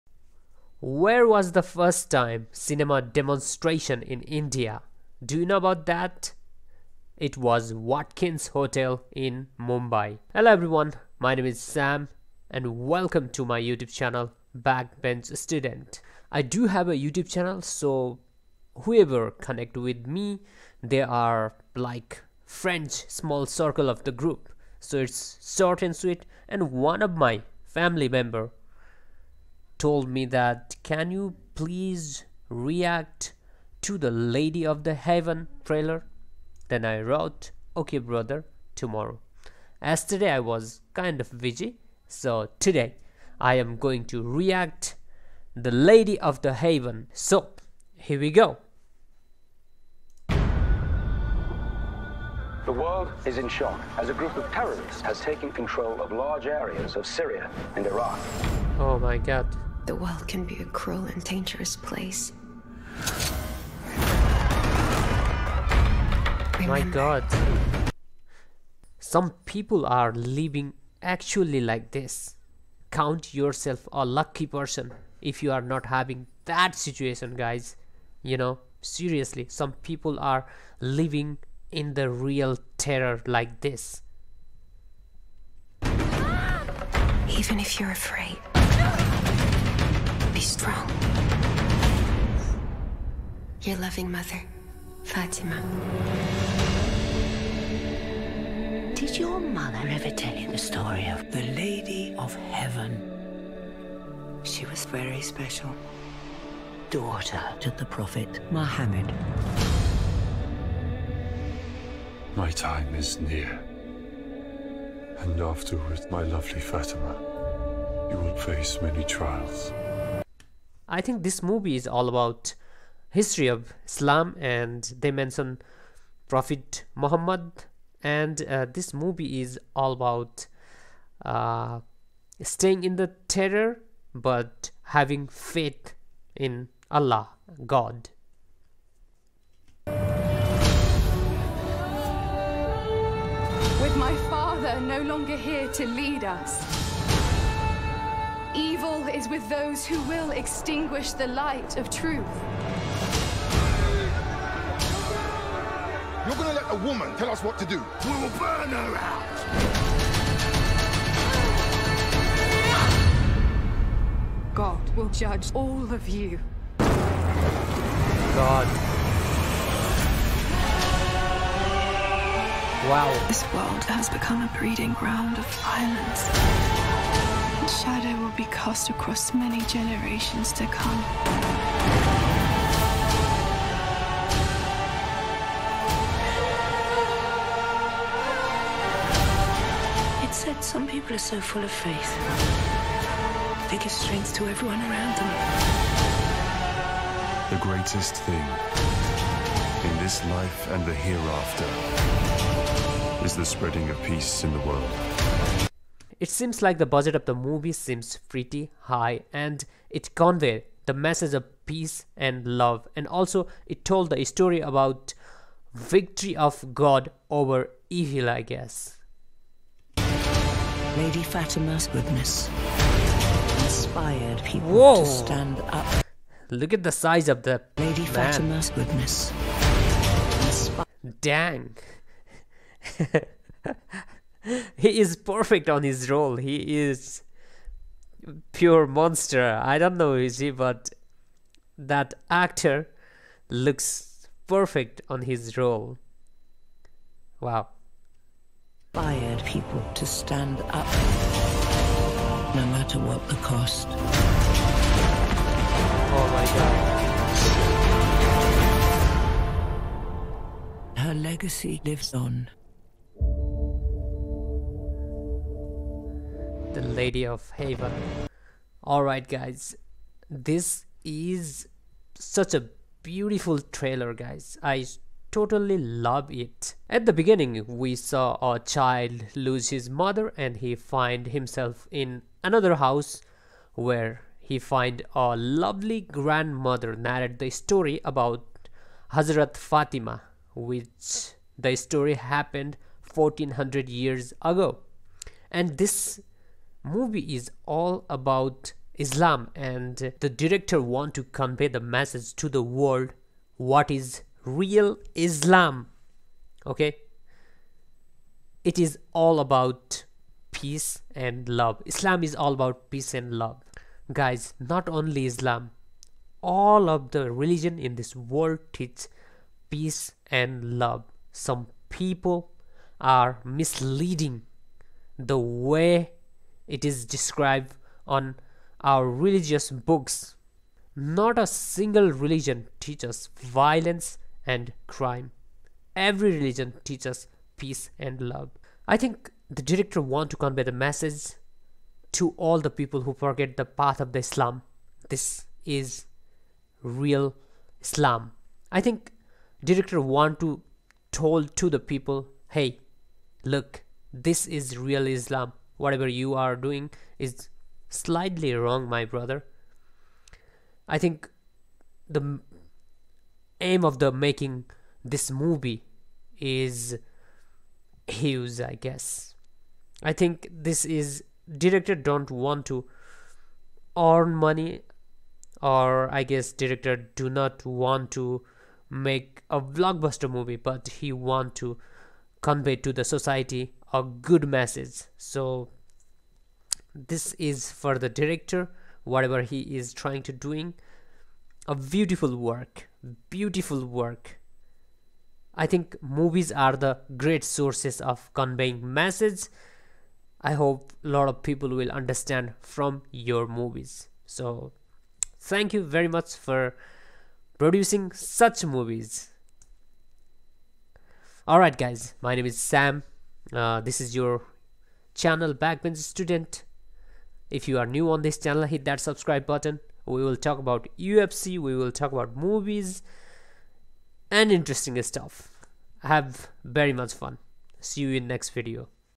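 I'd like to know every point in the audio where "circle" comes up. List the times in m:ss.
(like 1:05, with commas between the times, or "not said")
0:23.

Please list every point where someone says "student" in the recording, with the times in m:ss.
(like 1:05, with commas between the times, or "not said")
0:15, 6:55.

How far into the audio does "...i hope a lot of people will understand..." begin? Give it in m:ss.
6:40.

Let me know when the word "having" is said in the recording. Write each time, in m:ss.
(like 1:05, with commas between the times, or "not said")
1:15, 2:14.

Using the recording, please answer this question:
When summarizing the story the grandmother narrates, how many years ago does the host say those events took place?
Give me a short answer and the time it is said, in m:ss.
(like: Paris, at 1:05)
1400, at 4:53.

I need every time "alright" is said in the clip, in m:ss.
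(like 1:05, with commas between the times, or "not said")
4:28, 6:51.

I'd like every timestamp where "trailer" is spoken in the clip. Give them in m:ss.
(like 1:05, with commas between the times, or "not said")
0:35, 4:33.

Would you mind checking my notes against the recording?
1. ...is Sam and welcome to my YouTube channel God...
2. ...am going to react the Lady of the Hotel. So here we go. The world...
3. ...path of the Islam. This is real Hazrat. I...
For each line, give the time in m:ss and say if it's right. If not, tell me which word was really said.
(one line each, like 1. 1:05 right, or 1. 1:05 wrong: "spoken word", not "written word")
1. 0:11 wrong: "Backbench", not "God"
2. 0:43 wrong: "Heaven", not "Hotel"
3. 5:43 wrong: "Islam", not "Hazrat".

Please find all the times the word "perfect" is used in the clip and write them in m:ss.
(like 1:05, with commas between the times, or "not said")
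3:55, 4:04.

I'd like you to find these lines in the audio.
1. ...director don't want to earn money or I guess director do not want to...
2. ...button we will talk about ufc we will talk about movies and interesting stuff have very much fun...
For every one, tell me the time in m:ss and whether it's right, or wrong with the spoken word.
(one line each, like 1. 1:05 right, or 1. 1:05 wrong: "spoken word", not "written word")
1. 6:11 right
2. 6:59 right.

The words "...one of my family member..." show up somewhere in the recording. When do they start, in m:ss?
0:26.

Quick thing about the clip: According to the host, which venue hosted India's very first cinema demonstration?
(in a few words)
Watkins Hotel.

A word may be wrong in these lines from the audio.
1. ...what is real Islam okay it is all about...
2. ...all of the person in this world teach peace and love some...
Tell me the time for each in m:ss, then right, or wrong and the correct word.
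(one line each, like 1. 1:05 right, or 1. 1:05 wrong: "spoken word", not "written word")
1. 5:03 right
2. 5:16 wrong: "religion", not "person".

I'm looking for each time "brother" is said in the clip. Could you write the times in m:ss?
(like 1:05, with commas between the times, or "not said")
0:37, 5:59.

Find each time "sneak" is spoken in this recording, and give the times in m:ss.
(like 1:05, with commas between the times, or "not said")
not said.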